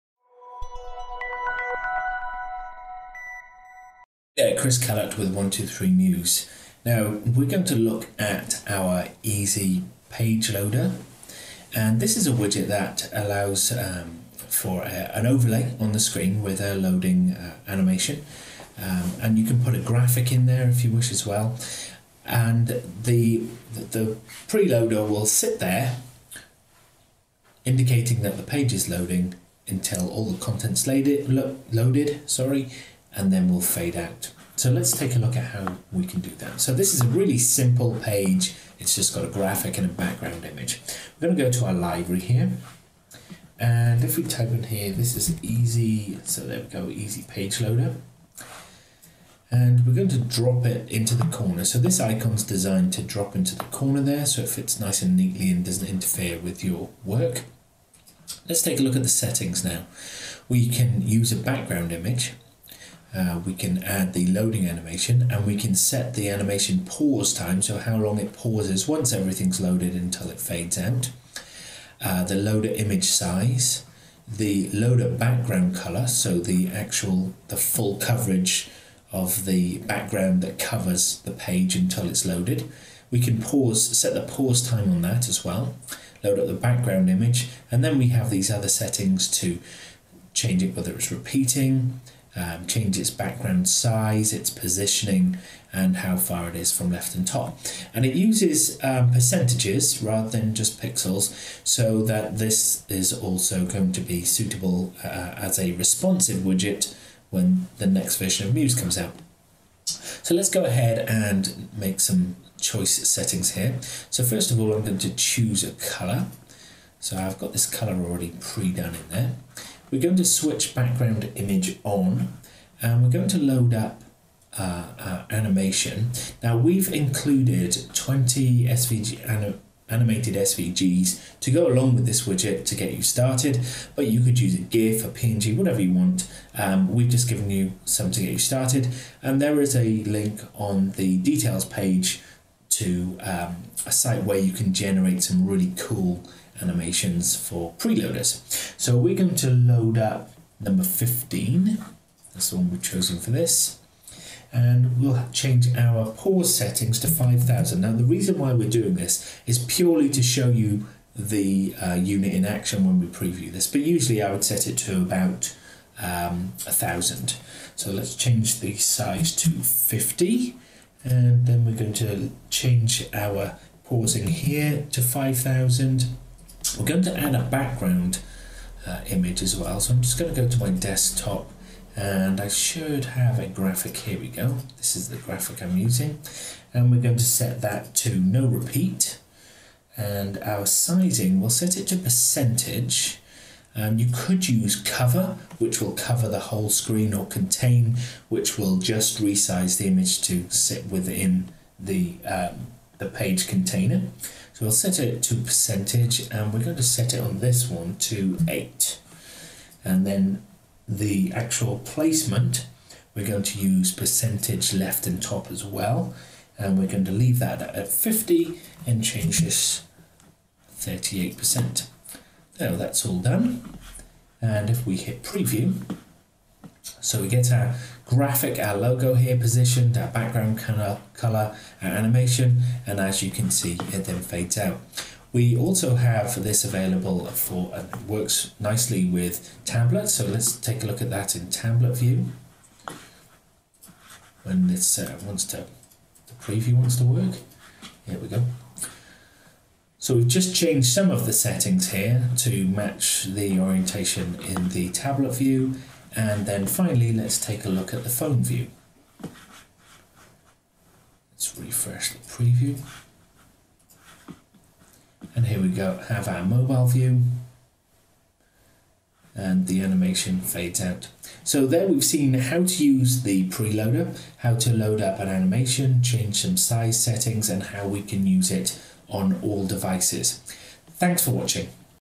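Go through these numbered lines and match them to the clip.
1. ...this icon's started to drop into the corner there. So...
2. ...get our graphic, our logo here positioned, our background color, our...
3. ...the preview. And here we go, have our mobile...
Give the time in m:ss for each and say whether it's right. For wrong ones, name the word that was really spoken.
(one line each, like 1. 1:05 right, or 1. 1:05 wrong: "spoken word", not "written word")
1. 0:51 wrong: "designed", not "started"
2. 3:47 right
3. 4:22 right.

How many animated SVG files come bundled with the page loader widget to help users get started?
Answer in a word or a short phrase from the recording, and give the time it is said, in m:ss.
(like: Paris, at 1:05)
20, at 2:07.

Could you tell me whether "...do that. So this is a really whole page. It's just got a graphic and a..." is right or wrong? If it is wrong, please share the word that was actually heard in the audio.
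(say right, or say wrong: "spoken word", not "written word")
wrong: "simple", not "whole".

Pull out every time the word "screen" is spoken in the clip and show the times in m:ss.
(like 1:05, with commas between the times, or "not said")
0:15, 3:16.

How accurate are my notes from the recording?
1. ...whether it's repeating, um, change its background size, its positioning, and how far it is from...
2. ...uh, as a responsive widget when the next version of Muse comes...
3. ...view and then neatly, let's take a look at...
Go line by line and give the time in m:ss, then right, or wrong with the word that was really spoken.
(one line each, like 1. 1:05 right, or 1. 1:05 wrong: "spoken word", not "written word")
1. 1:30 right
2. 1:45 right
3. 4:15 wrong: "finally", not "neatly".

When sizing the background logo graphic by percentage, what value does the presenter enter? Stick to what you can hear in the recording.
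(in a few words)
8.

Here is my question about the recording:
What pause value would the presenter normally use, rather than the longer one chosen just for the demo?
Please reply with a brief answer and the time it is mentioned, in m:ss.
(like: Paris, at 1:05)
1,000, at 2:46.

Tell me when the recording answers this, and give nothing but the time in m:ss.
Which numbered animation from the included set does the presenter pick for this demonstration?
2:30.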